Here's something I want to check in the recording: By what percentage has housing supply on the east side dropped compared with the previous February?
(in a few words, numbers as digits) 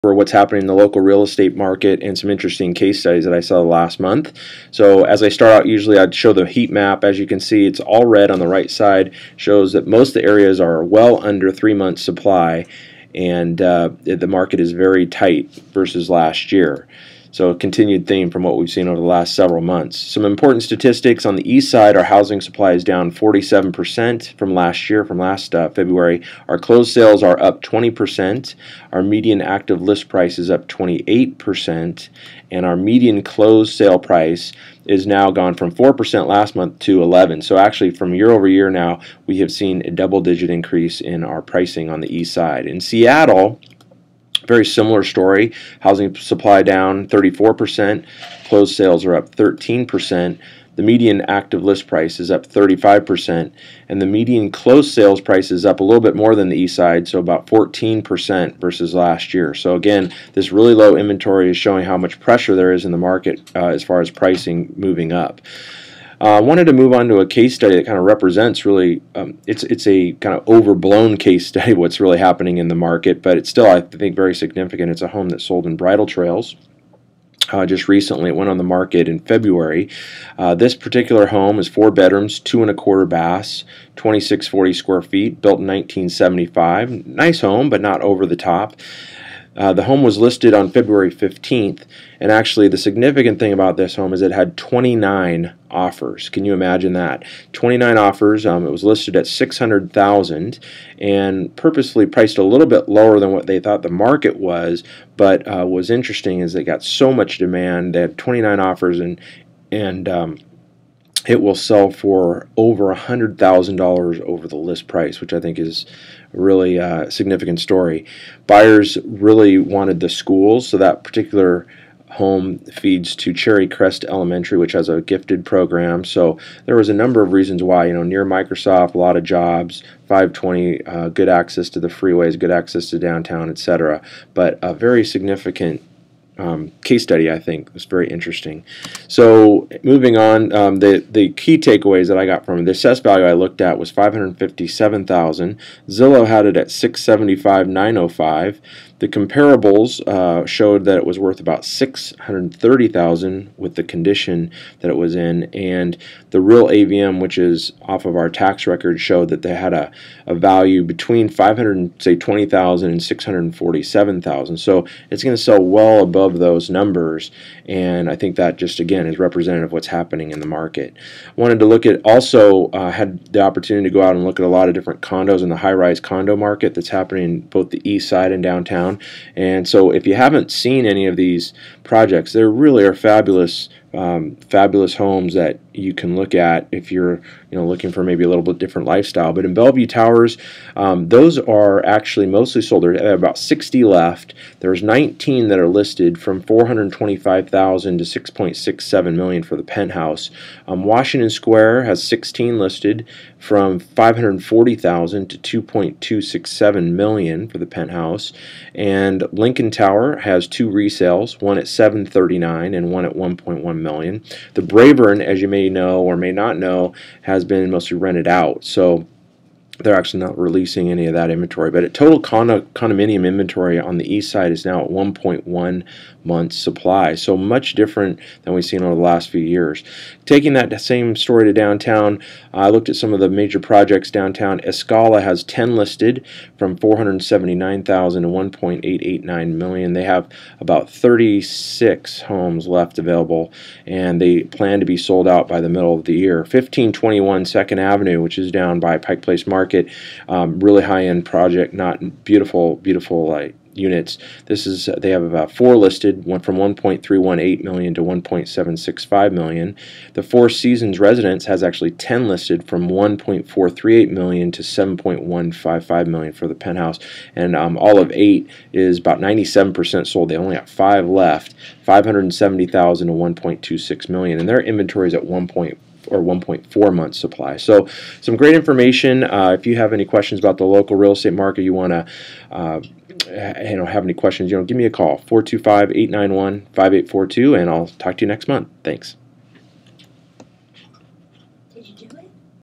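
47%.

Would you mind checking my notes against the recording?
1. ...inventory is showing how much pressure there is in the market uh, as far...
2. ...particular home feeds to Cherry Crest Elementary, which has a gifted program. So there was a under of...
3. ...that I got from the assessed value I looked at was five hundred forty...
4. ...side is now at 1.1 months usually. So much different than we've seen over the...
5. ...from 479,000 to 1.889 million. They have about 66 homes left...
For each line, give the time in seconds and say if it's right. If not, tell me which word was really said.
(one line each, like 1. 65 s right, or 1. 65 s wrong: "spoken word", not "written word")
1. 60 s right
2. 121 s wrong: "number", not "under"
3. 142 s wrong: "fifty", not "forty"
4. 224 s wrong: "supply", not "usually"
5. 236 s wrong: "36", not "66".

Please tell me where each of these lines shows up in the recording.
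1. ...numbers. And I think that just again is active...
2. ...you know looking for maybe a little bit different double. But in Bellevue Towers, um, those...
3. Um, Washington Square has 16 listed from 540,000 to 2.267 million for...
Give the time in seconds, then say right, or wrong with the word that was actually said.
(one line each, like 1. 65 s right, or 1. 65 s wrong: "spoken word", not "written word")
1. 166 s wrong: "representative", not "active"
2. 187 s wrong: "lifestyle", not "double"
3. 200 s right.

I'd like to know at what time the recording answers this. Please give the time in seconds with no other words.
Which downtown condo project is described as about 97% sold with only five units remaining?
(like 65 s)
267 s.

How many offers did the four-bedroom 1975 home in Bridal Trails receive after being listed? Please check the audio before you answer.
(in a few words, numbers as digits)
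29.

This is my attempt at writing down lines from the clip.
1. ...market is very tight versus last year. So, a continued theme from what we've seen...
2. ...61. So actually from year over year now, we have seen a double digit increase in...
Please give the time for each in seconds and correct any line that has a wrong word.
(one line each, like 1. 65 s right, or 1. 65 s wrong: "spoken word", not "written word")
1. 14 s right
2. 37 s wrong: "11", not "61".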